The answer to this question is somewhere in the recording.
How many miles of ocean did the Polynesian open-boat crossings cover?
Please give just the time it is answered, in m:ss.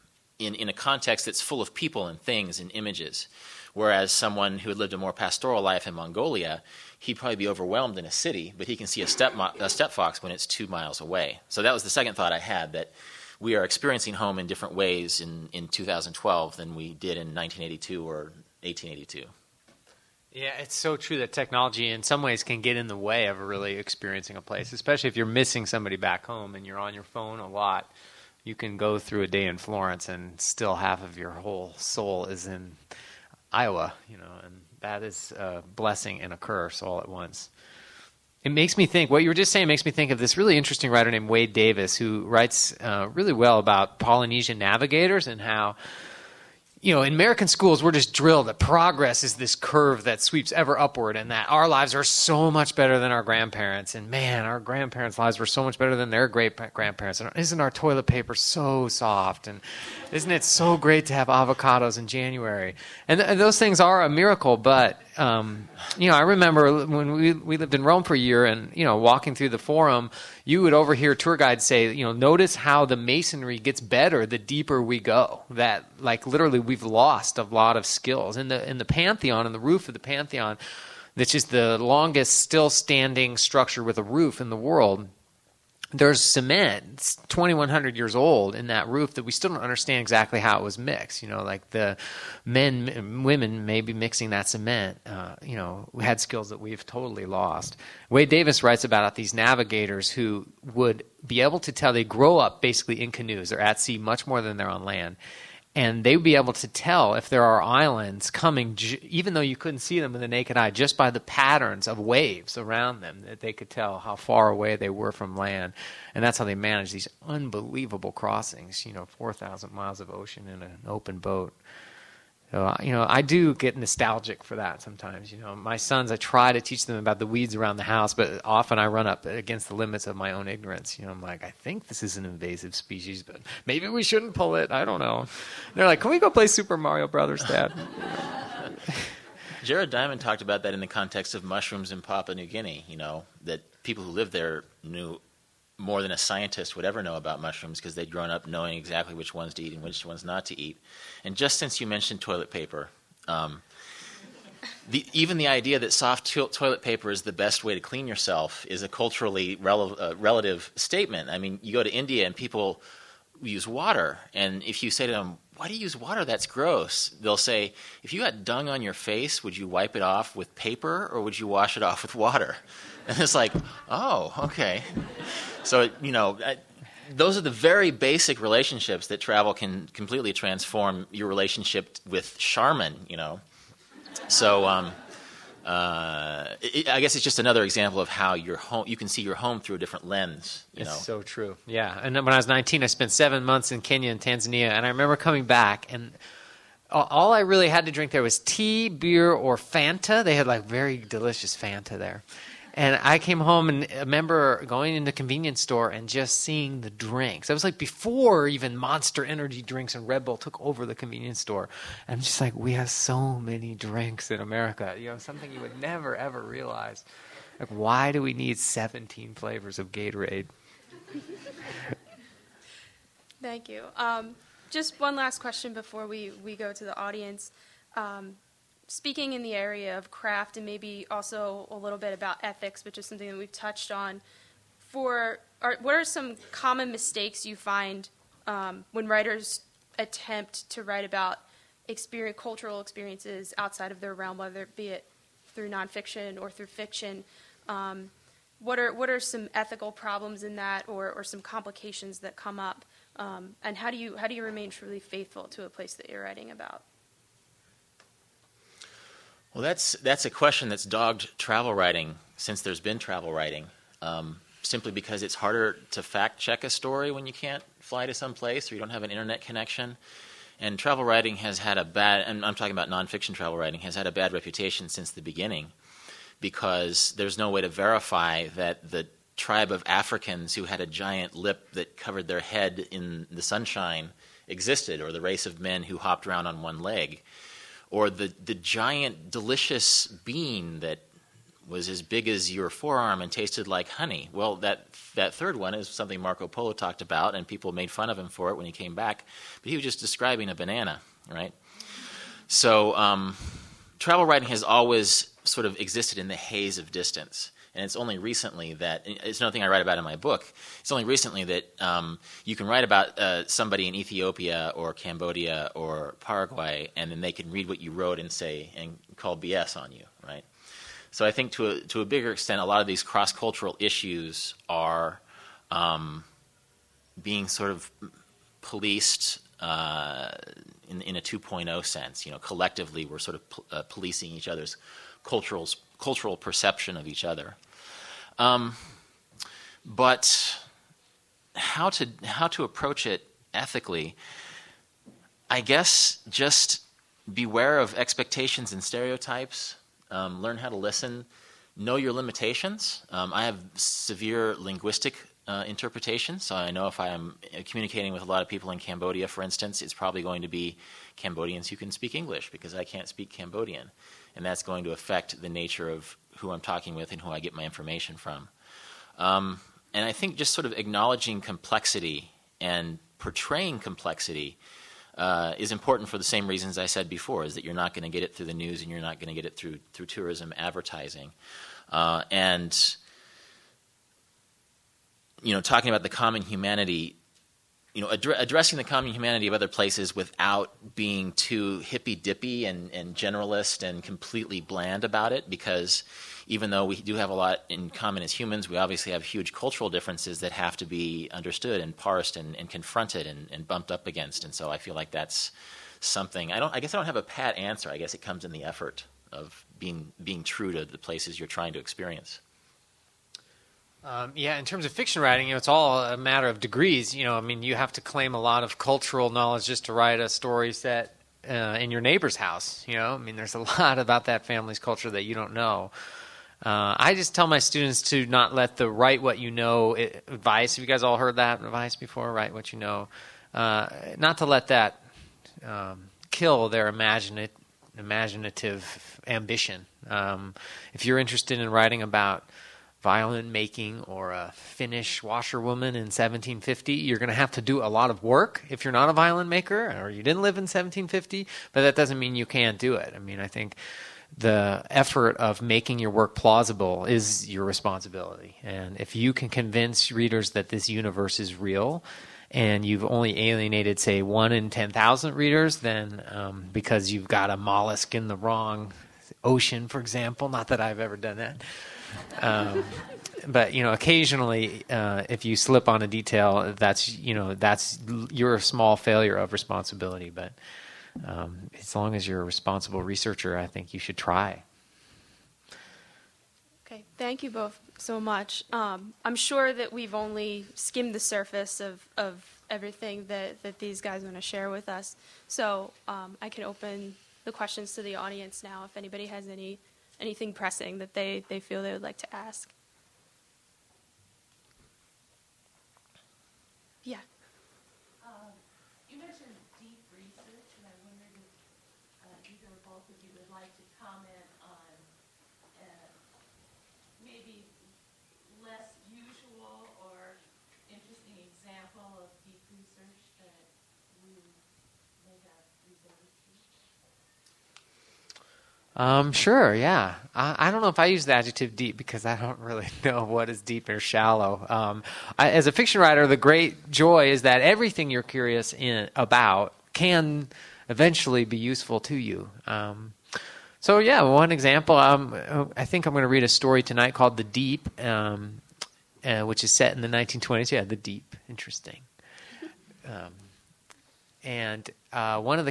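1:59.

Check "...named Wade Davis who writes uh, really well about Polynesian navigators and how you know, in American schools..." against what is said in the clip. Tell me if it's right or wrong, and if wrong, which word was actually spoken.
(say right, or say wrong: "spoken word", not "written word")
right.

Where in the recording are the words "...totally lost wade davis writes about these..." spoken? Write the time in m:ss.
1:36.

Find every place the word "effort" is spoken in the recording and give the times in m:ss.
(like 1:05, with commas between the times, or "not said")
6:48, 7:34.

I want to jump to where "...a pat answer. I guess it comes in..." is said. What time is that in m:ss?
6:47.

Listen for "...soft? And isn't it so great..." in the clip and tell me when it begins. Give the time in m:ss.
0:58.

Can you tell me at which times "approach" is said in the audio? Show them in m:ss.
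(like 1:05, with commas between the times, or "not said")
5:42.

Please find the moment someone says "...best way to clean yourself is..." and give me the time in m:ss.
2:37.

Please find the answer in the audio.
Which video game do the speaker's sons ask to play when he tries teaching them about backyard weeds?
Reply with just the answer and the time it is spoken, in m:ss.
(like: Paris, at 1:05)
Super Mario Brothers, at 2:16.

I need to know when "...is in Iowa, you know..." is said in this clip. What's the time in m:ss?
0:32.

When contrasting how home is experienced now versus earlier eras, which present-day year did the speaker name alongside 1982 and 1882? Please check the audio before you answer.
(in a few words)
2012.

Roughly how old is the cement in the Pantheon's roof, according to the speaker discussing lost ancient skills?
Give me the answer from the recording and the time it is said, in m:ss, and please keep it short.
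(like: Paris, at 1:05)
2100 years, at 1:27.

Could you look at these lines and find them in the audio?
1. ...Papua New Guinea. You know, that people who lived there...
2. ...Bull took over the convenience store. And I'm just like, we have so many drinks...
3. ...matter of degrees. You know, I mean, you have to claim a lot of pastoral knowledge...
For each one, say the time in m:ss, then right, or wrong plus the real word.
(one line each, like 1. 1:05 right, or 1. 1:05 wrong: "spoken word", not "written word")
1. 2:22 right
2. 3:30 right
3. 6:56 wrong: "cultural", not "pastoral".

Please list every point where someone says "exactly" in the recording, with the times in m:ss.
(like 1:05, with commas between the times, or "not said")
1:30, 2:28.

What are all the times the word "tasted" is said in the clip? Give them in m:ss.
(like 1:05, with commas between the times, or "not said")
4:53.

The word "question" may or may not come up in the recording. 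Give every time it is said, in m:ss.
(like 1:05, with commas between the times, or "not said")
3:45, 4:20, 8:17.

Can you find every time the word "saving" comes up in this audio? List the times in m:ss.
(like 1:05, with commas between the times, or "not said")
not said.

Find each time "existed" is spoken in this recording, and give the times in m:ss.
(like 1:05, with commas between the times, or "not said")
4:44, 5:05.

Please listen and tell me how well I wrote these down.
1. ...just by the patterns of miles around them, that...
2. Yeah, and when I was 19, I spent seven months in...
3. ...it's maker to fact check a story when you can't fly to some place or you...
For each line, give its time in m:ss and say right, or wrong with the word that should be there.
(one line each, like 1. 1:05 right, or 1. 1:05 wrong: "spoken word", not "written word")
1. 1:50 wrong: "waves", not "miles"
2. 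3:11 right
3. 4:25 wrong: "harder", not "maker".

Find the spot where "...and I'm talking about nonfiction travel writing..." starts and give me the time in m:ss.
4:32.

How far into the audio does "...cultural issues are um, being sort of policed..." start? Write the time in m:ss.
5:23.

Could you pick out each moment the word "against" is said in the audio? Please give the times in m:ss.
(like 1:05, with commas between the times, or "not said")
2:09, 6:44.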